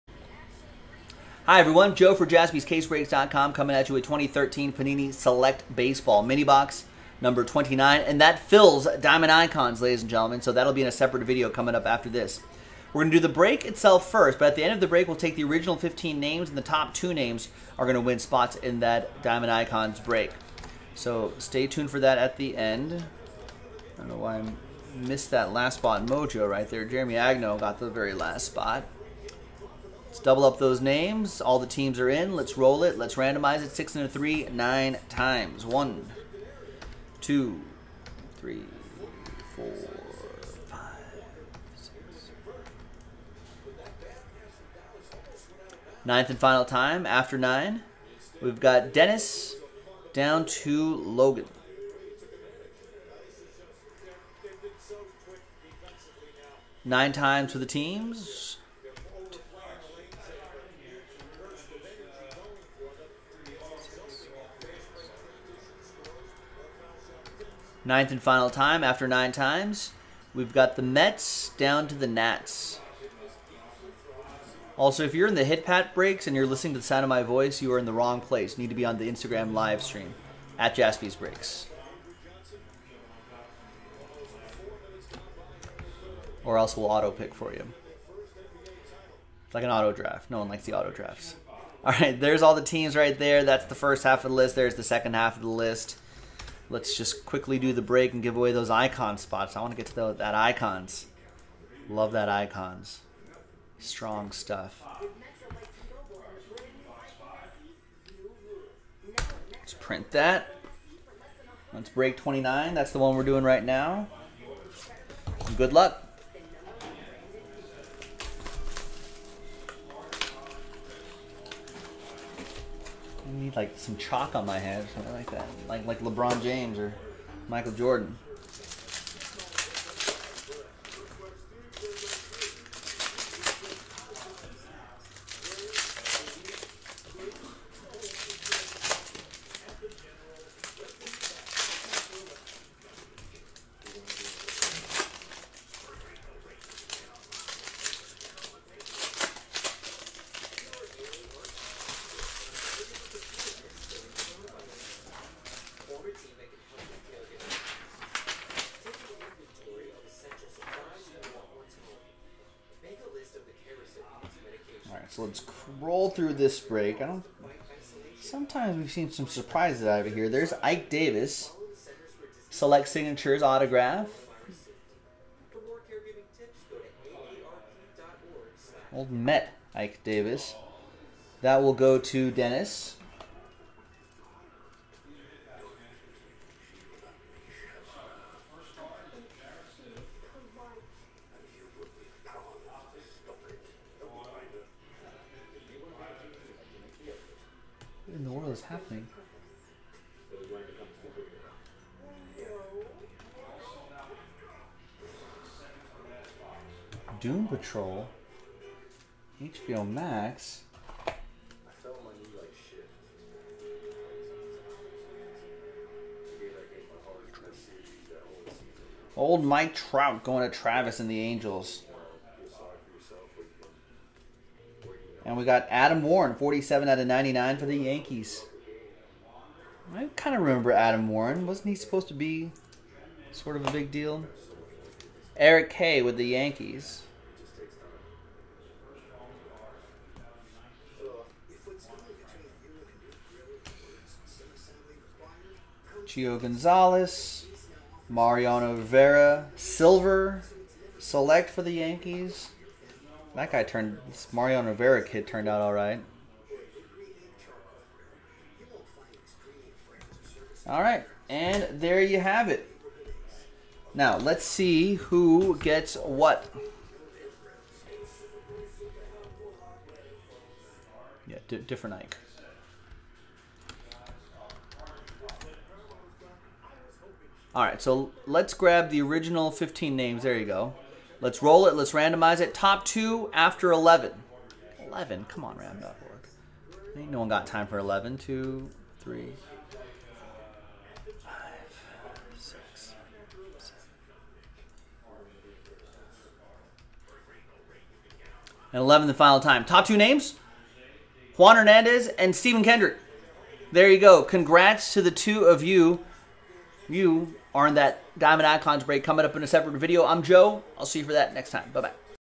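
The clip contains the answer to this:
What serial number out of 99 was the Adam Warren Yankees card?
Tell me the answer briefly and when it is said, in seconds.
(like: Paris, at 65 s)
47, at 226 s.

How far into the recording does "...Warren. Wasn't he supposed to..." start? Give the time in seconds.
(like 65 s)
231 s.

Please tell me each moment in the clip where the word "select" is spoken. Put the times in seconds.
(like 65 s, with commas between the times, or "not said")
5 s, 172 s, 250 s.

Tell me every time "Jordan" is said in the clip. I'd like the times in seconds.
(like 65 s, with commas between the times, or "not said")
127 s.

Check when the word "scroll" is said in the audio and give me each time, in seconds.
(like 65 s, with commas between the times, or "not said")
165 s.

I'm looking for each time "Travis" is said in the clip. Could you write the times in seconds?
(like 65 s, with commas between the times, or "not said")
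220 s.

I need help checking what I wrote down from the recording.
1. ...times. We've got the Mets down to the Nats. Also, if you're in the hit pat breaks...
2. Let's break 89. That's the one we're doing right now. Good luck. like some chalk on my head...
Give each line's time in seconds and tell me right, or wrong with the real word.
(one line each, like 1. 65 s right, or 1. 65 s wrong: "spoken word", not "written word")
1. 69 s right
2. 111 s wrong: "29", not "89".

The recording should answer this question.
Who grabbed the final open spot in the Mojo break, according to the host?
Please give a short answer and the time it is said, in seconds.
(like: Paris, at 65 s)
Jeremy Agno, at 26 s.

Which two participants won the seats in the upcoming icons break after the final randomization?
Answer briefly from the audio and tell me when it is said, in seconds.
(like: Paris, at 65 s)
Juan Hernandez and Stephen Kendrick, at 301 s.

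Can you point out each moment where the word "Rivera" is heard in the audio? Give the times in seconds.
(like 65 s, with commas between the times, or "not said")
248 s, 254 s.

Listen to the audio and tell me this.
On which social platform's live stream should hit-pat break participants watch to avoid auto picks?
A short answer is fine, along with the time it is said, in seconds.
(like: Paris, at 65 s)
Instagram, at 79 s.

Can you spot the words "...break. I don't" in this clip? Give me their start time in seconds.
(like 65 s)
166 s.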